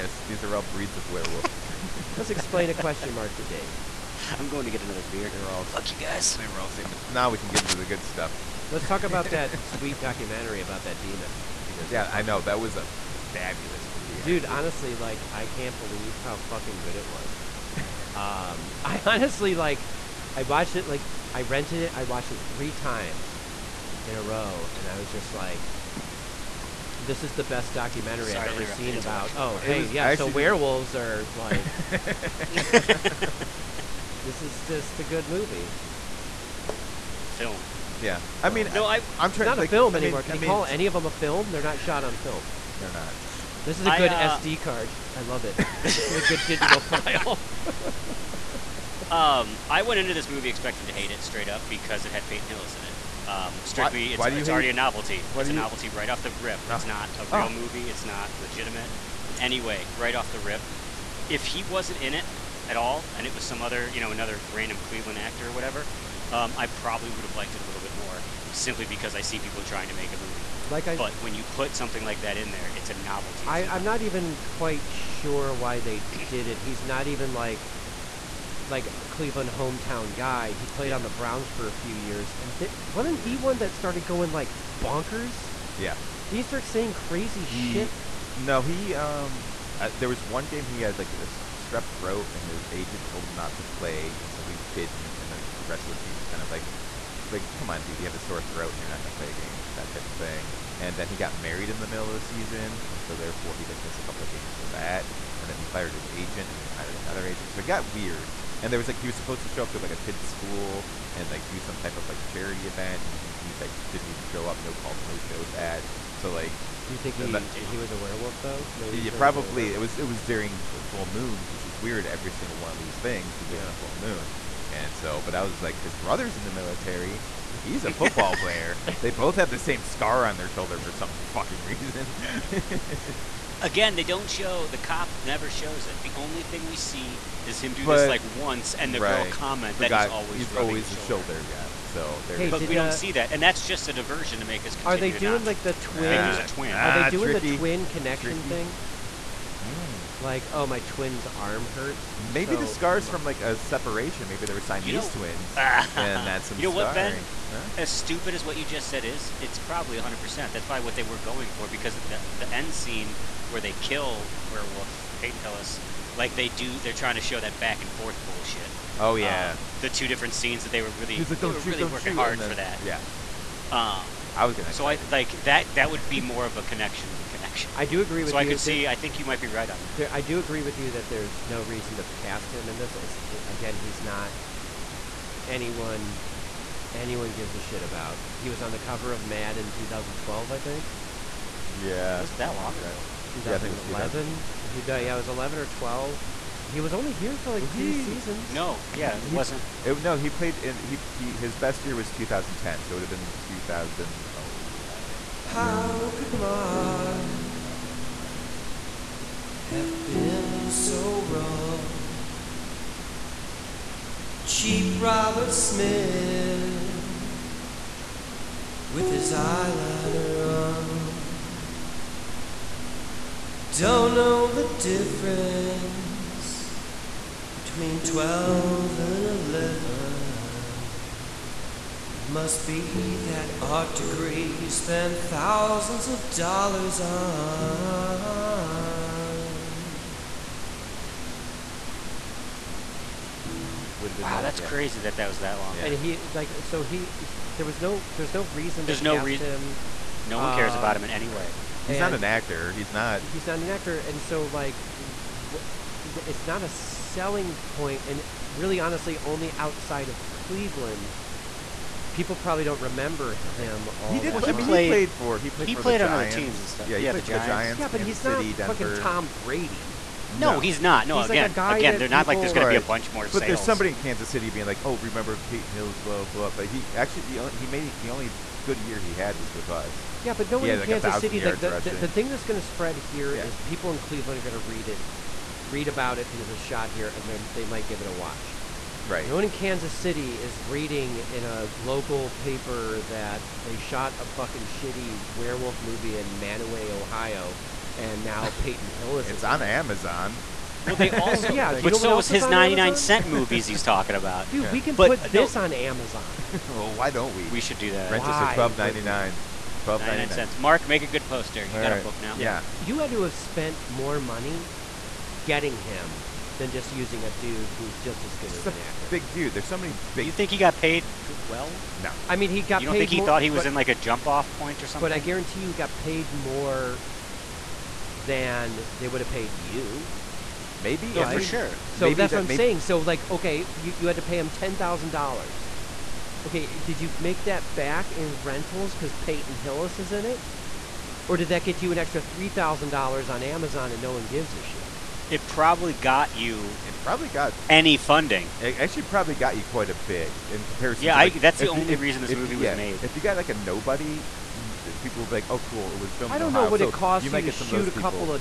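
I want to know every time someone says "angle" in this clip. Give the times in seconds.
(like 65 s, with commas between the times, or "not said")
not said.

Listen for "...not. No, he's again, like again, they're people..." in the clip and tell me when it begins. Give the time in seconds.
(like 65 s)
270 s.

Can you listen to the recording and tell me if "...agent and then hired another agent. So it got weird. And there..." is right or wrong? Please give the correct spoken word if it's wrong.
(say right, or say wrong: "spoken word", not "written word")
right.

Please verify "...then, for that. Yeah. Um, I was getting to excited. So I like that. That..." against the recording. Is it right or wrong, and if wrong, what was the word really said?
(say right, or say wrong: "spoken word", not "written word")
right.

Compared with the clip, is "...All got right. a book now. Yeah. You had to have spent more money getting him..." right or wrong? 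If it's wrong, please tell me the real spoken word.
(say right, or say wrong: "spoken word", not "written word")
right.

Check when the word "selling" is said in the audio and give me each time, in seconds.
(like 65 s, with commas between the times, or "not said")
256 s.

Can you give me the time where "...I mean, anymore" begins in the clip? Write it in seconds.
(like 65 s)
39 s.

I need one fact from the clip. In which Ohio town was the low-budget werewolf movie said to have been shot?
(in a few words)
Mantua.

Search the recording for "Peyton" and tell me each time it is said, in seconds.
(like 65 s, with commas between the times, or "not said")
52 s, 165 s, 275 s, 298 s, 339 s.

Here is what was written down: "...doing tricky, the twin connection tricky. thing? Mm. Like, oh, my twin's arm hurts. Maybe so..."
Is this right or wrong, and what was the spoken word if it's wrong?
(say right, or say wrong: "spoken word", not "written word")
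right.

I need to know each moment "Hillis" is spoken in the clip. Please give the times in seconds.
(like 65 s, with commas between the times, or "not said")
52 s, 165 s, 275 s, 298 s, 339 s.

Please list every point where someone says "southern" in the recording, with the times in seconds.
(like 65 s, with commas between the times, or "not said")
not said.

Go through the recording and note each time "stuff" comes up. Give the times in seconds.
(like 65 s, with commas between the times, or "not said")
8 s, 266 s.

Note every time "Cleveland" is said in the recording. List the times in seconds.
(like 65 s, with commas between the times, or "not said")
64 s, 79 s, 260 s, 283 s.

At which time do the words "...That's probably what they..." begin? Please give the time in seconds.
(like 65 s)
160 s.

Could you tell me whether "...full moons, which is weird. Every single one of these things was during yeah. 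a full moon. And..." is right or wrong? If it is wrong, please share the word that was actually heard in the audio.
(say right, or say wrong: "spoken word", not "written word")
right.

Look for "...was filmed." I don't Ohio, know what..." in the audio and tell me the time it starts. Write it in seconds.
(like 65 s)
355 s.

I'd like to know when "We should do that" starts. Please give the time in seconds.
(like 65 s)
307 s.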